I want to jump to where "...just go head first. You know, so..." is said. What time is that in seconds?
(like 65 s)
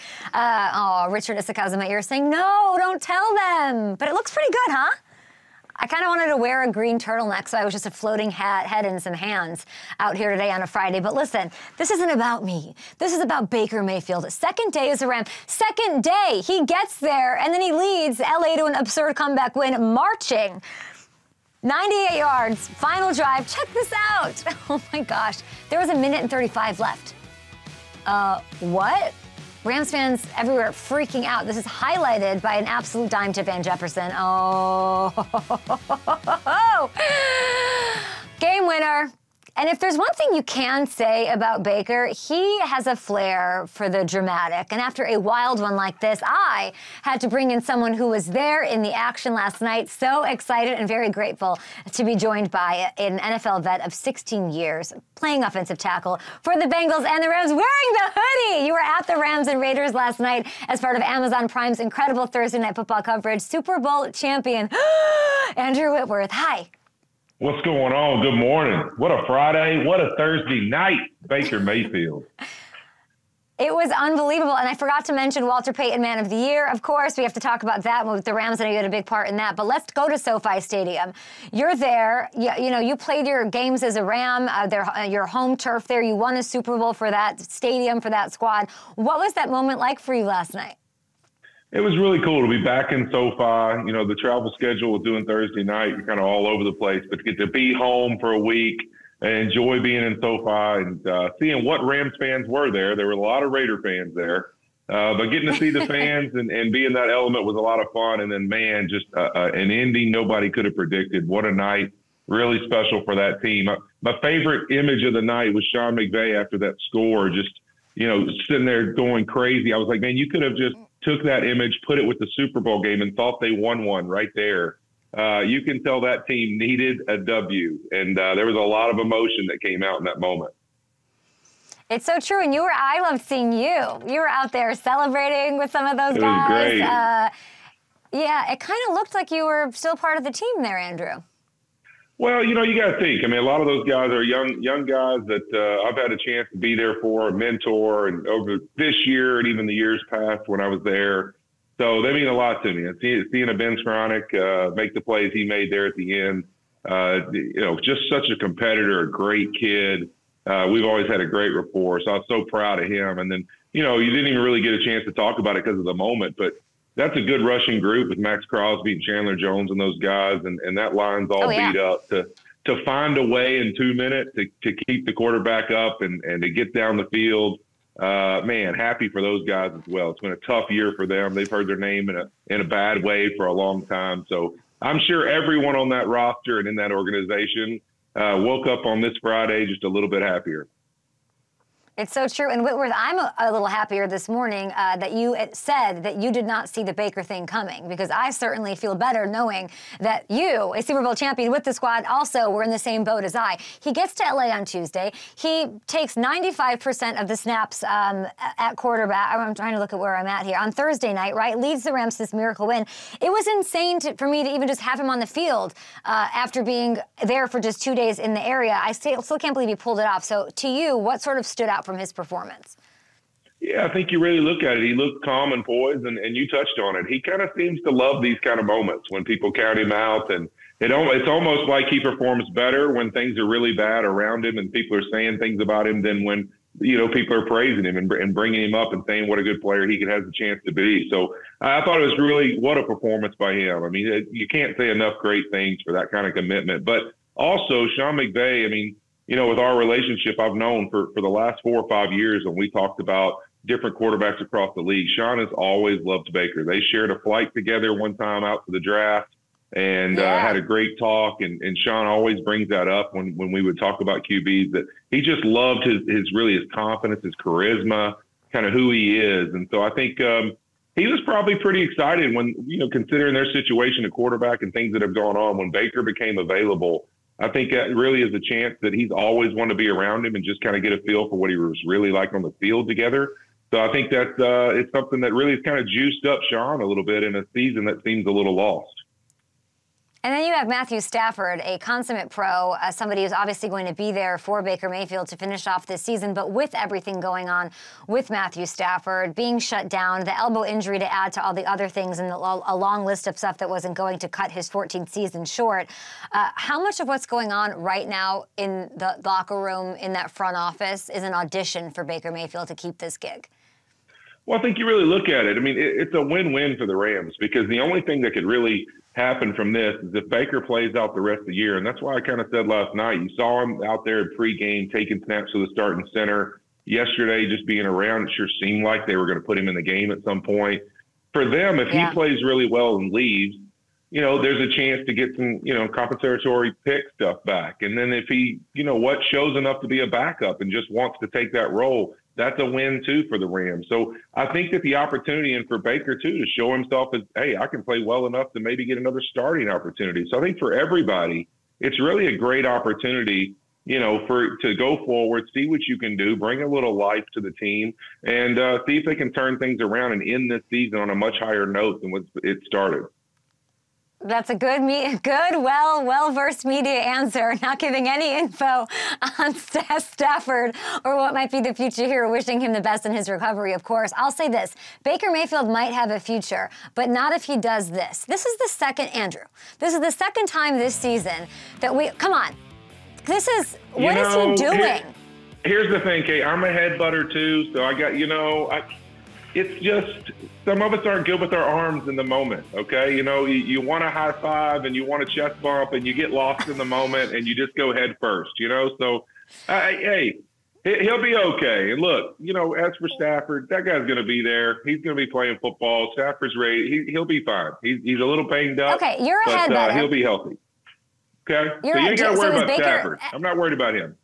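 397 s.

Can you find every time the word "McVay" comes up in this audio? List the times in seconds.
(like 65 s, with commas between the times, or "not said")
115 s, 248 s.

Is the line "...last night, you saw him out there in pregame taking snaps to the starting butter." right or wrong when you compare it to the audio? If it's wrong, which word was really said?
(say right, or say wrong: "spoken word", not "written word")
wrong: "center", not "butter".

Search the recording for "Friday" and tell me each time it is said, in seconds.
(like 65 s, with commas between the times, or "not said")
10 s, 69 s, 189 s.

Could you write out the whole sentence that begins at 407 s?
He's, he's a little banged up.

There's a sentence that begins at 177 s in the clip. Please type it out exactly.
Uh, man, happy for those guys as well.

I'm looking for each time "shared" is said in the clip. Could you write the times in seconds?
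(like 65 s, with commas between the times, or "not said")
256 s.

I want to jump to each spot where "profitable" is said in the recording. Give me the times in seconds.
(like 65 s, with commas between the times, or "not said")
not said.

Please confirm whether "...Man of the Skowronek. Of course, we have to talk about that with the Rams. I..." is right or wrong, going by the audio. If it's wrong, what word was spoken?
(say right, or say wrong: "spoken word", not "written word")
wrong: "Year", not "Skowronek".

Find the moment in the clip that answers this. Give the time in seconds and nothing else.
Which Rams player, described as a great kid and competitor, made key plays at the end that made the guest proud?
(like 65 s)
153 s.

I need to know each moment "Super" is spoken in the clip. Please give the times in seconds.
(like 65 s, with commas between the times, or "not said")
63 s, 86 s, 122 s, 200 s.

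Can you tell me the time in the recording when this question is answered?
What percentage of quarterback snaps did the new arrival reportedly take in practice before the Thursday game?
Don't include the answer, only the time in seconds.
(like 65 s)
206 s.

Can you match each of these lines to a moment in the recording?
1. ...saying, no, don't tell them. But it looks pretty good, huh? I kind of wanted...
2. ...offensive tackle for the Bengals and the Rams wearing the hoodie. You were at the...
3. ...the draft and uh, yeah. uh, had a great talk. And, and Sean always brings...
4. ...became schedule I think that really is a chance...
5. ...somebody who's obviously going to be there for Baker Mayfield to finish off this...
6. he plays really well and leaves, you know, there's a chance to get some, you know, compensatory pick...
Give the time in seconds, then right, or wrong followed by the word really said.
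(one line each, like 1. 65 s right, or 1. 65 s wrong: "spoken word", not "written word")
1. 2 s right
2. 55 s right
3. 258 s right
4. 276 s wrong: "available", not "schedule"
5. 292 s right
6. 332 s right.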